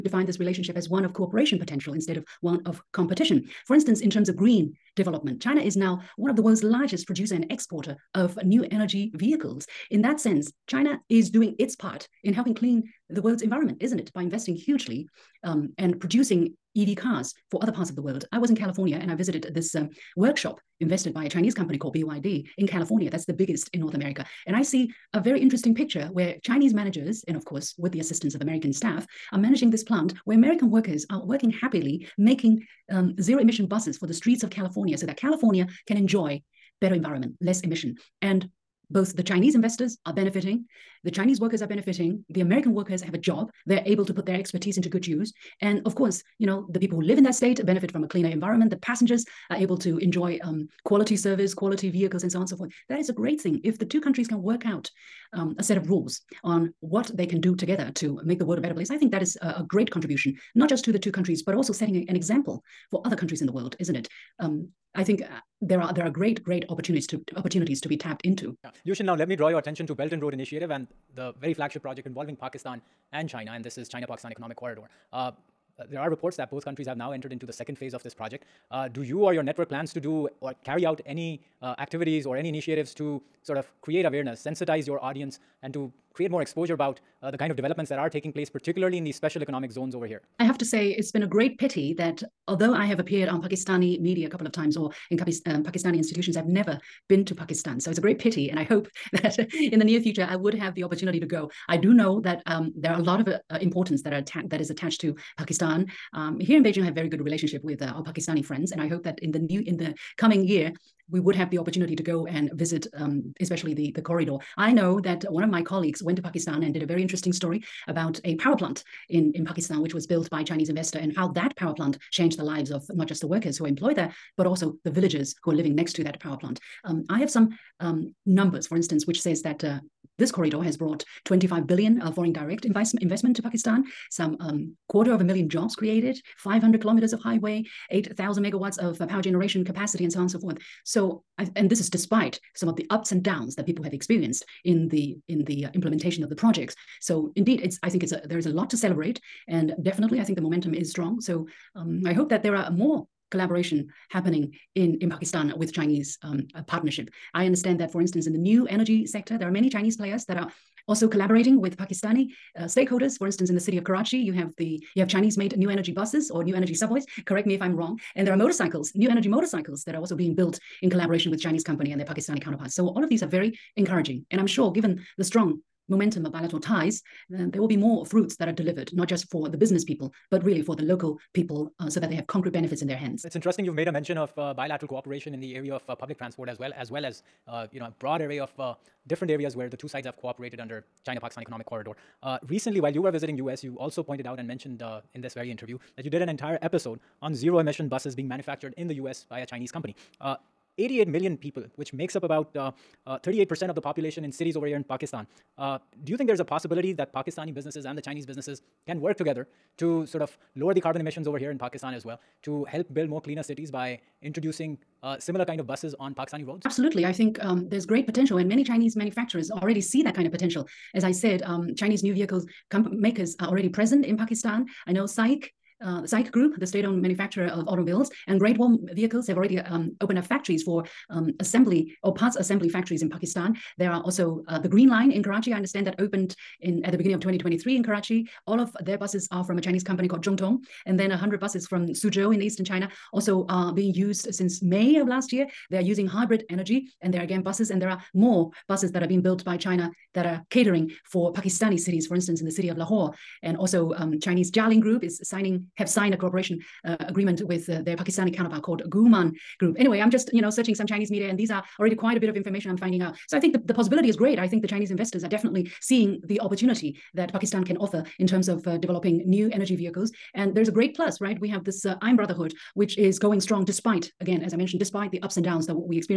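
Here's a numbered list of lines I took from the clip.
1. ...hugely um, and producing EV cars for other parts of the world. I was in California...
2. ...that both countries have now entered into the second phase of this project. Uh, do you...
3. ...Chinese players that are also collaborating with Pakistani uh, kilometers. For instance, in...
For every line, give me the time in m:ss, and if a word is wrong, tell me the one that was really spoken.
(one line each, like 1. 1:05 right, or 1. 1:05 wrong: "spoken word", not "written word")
1. 0:14 right
2. 1:16 right
3. 2:39 wrong: "stakeholders", not "kilometers".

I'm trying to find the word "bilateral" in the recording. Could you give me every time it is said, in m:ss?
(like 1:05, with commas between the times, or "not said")
2:56, 3:04.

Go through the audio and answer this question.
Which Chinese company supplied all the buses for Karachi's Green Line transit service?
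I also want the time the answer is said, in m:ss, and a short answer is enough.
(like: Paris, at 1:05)
Zhongtong, at 4:00.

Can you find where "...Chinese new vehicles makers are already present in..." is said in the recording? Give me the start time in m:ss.
3:41.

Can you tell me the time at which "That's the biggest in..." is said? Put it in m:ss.
0:23.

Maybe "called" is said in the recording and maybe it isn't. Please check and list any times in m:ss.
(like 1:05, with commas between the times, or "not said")
0:21, 4:00, 4:18.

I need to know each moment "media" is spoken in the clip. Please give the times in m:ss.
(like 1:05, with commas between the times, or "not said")
1:33, 4:21.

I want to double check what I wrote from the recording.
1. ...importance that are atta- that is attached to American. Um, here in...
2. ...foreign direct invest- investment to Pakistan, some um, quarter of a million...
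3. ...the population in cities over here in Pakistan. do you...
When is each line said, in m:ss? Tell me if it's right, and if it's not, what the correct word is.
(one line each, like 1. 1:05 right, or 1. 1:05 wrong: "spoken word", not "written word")
1. 1:43 wrong: "Pakistan", not "American"
2. 2:12 right
3. 3:23 right.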